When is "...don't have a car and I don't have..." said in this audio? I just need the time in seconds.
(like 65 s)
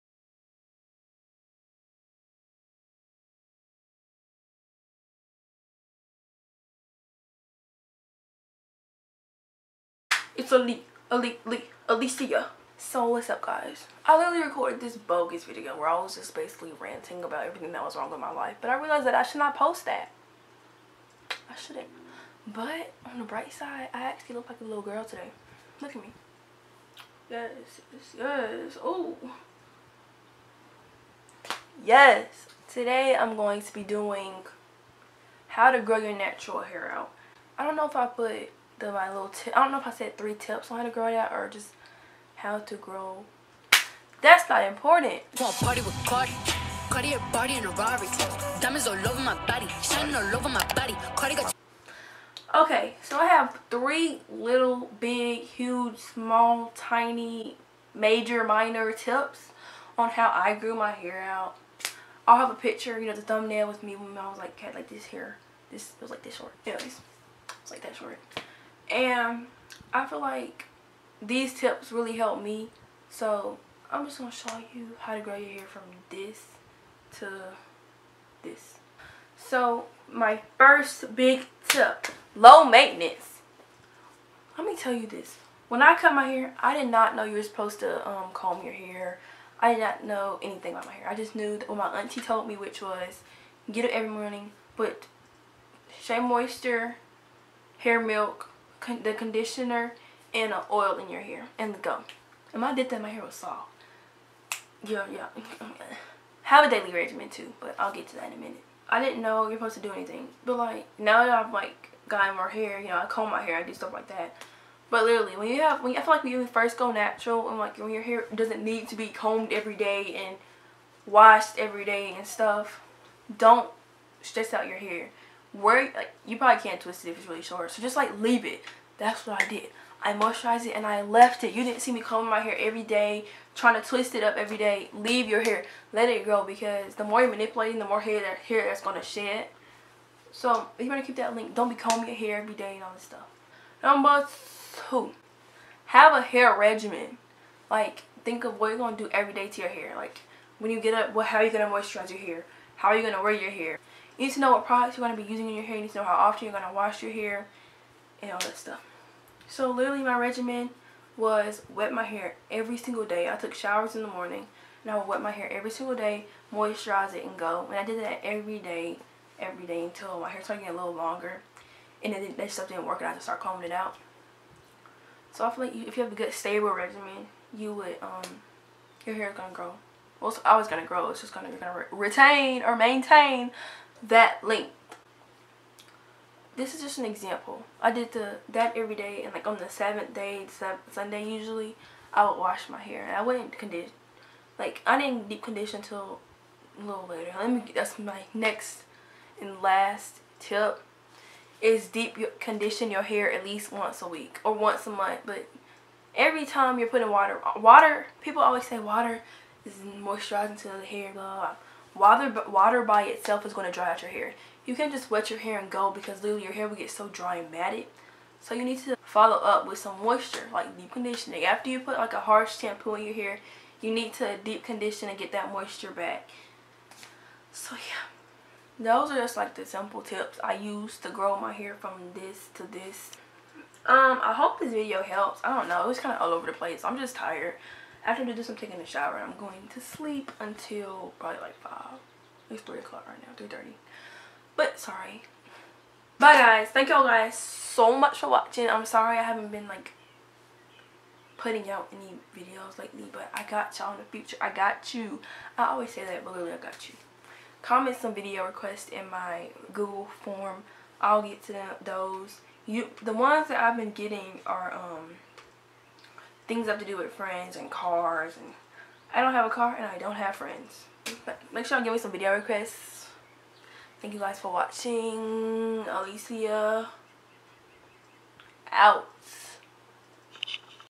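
269 s.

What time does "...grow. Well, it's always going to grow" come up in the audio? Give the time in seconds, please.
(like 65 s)
179 s.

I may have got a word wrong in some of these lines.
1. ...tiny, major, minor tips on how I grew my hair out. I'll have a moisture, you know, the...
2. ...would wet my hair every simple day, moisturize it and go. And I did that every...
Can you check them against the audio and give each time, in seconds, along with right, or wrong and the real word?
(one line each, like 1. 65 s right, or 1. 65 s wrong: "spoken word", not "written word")
1. 56 s wrong: "picture", not "moisture"
2. 164 s wrong: "single", not "simple".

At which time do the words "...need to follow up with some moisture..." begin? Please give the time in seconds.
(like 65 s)
218 s.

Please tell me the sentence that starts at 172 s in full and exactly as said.
And then that stuff didn't work and I just started combing it out.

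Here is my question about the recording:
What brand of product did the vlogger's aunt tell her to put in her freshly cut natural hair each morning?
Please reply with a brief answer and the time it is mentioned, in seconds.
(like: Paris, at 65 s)
Shea Moisture, at 96 s.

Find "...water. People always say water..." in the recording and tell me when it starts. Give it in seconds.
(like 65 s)
207 s.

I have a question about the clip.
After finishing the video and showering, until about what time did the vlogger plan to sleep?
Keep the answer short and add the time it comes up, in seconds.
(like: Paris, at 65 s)
5, at 241 s.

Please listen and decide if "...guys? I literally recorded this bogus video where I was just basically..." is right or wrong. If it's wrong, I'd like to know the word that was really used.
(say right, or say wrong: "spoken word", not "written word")
right.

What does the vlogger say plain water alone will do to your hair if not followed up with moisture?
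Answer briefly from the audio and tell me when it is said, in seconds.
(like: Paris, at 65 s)
dry out your hair, at 213 s.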